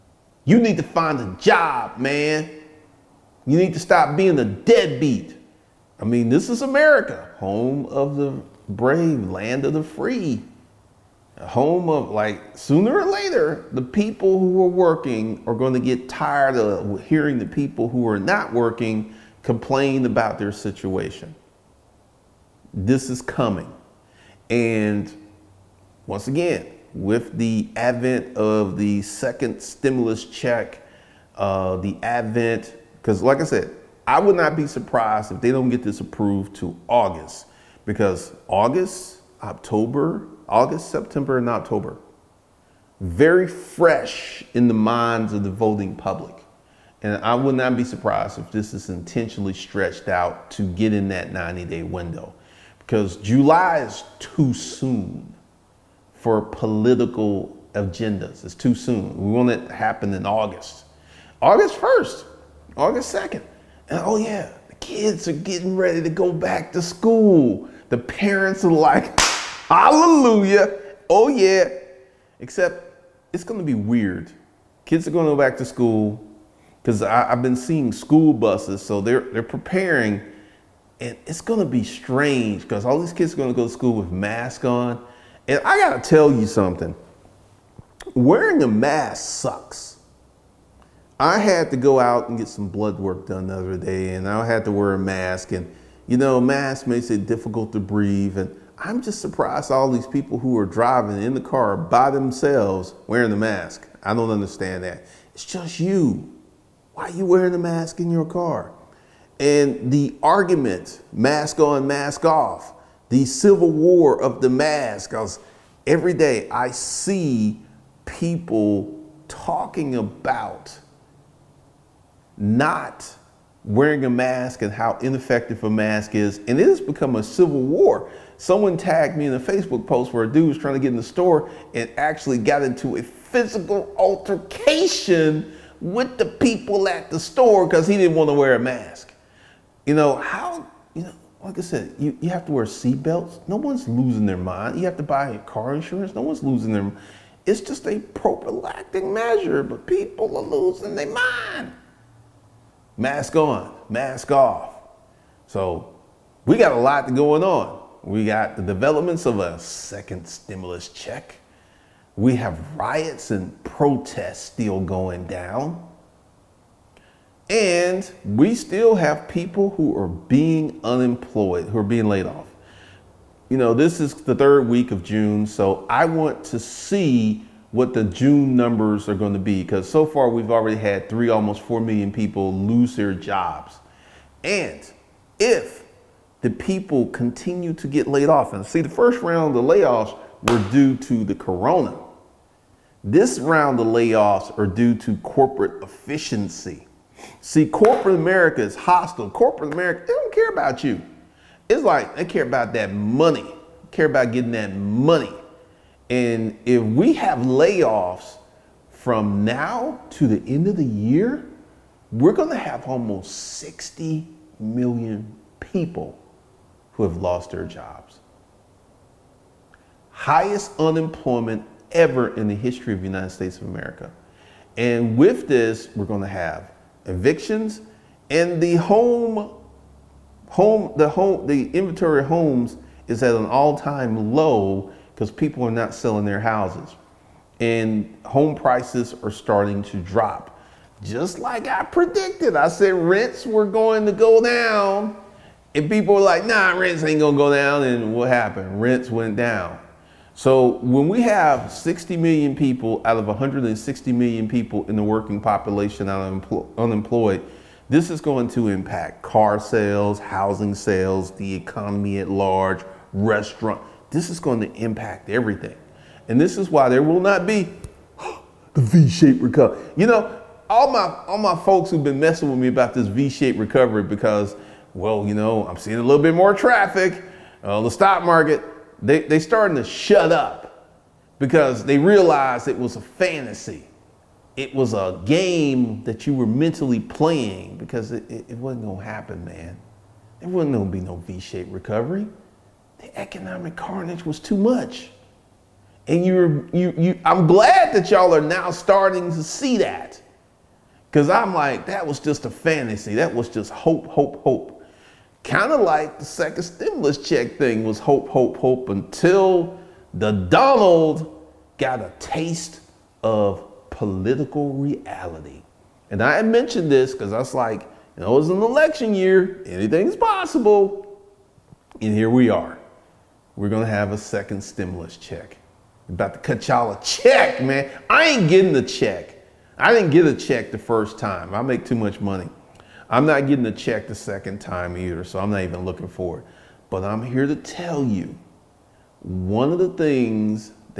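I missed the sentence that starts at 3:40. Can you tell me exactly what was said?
Highest unemployment ever in the history of the United States of America.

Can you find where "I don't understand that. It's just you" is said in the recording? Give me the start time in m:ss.
1:44.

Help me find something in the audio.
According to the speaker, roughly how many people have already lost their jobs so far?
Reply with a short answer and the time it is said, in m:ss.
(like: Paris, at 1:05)
almost 4 million, at 3:01.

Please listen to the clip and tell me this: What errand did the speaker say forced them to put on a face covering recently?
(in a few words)
blood work.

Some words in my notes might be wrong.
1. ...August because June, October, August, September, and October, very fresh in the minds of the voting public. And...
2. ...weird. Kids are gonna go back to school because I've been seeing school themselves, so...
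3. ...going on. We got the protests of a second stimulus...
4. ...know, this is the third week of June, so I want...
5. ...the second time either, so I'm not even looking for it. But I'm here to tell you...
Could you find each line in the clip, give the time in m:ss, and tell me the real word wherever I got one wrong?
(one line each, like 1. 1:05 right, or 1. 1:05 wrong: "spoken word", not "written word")
1. 0:36 wrong: "August", not "June"
2. 1:13 wrong: "buses", not "themselves"
3. 2:37 wrong: "developments", not "protests"
4. 2:53 right
5. 5:34 right.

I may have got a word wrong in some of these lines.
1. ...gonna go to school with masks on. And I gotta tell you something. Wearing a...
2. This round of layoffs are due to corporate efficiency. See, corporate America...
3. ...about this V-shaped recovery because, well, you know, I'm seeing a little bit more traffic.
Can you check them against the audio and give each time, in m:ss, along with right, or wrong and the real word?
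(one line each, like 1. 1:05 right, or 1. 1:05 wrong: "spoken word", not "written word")
1. 1:23 right
2. 3:13 right
3. 4:32 right.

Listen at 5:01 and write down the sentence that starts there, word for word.
Because I'm like, that was just a fantasy.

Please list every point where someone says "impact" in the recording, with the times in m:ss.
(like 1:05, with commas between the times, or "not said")
4:18, 4:24.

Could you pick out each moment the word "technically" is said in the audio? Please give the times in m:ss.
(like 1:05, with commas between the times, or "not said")
not said.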